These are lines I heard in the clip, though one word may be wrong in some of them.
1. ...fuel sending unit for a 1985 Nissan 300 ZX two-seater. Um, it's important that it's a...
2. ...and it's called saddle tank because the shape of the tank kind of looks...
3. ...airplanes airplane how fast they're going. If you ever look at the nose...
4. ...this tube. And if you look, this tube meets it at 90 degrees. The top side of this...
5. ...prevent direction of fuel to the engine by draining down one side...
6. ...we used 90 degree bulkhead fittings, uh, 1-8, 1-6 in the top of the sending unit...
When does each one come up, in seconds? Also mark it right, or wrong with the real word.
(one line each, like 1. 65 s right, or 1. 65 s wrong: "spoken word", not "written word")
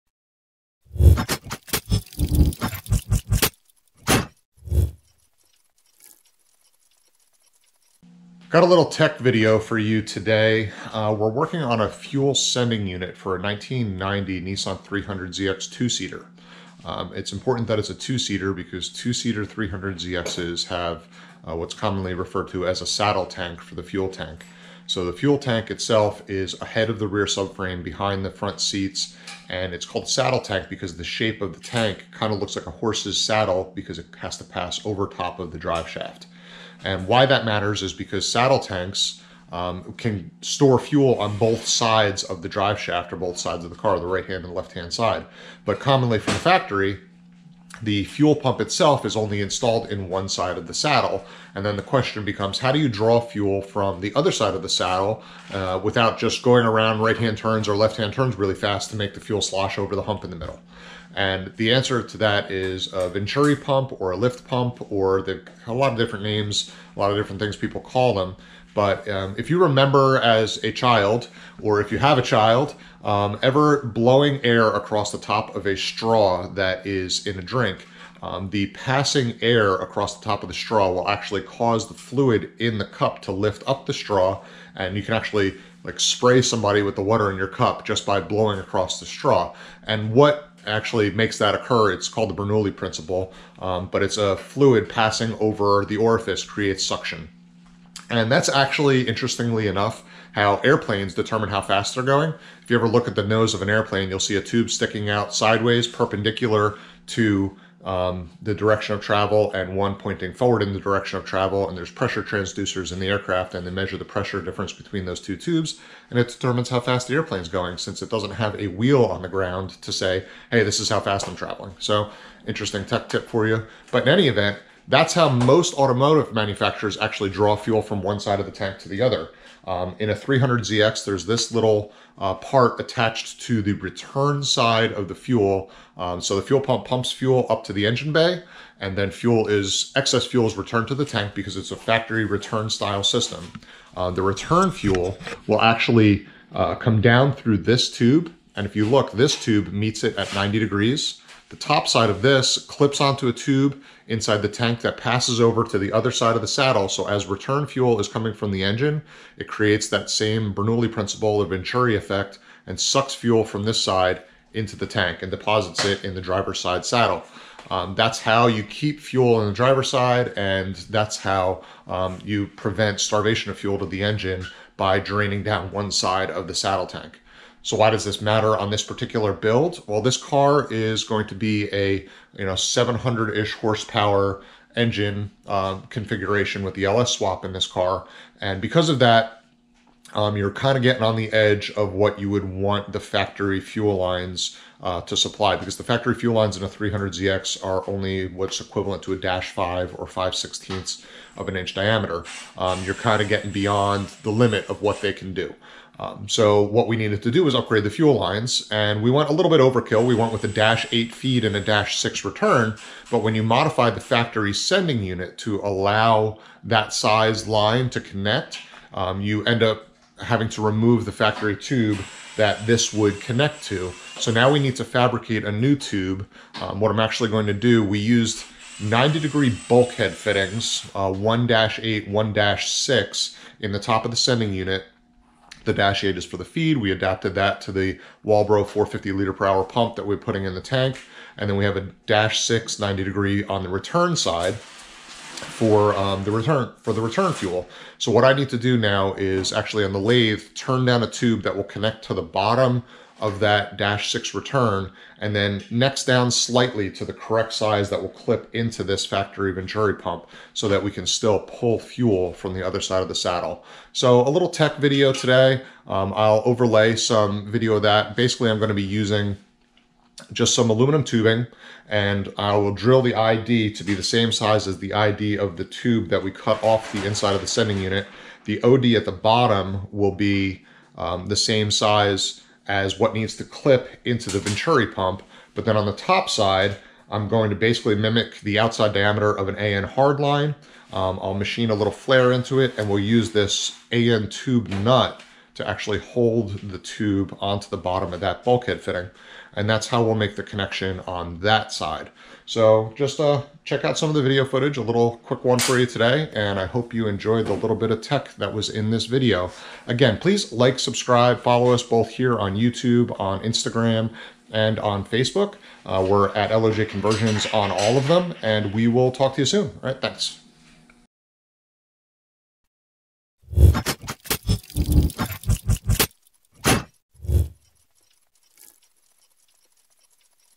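1. 11 s wrong: "1990", not "1985"
2. 29 s right
3. 100 s wrong: "determine", not "airplane"
4. 147 s right
5. 172 s wrong: "starvation", not "direction"
6. 227 s right.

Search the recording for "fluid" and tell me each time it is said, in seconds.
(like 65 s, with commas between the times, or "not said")
81 s, 94 s.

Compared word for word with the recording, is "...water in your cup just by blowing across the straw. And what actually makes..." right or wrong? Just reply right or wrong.
right.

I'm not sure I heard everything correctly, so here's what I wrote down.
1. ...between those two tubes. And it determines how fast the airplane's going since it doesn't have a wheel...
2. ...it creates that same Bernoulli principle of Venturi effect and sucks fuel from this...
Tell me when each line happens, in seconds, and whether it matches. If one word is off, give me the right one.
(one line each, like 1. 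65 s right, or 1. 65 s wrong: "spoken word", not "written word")
1. 114 s right
2. 159 s right.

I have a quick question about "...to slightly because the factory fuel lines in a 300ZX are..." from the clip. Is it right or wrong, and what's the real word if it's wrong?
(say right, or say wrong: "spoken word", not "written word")
wrong: "supply", not "slightly".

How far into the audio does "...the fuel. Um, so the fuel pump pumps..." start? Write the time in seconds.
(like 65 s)
135 s.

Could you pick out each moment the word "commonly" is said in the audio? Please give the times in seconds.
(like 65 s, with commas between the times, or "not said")
21 s, 45 s.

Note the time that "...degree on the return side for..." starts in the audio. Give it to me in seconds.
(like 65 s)
243 s.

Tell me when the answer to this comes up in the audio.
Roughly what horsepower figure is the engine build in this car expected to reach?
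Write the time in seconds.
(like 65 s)
182 s.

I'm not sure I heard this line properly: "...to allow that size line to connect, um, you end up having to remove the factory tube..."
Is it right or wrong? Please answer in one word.
right.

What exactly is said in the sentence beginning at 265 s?
Um, I'll overlay some video of that.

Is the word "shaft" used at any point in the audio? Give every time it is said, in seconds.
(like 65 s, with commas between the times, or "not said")
35 s, 42 s.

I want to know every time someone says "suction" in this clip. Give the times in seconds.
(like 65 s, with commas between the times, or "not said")
96 s.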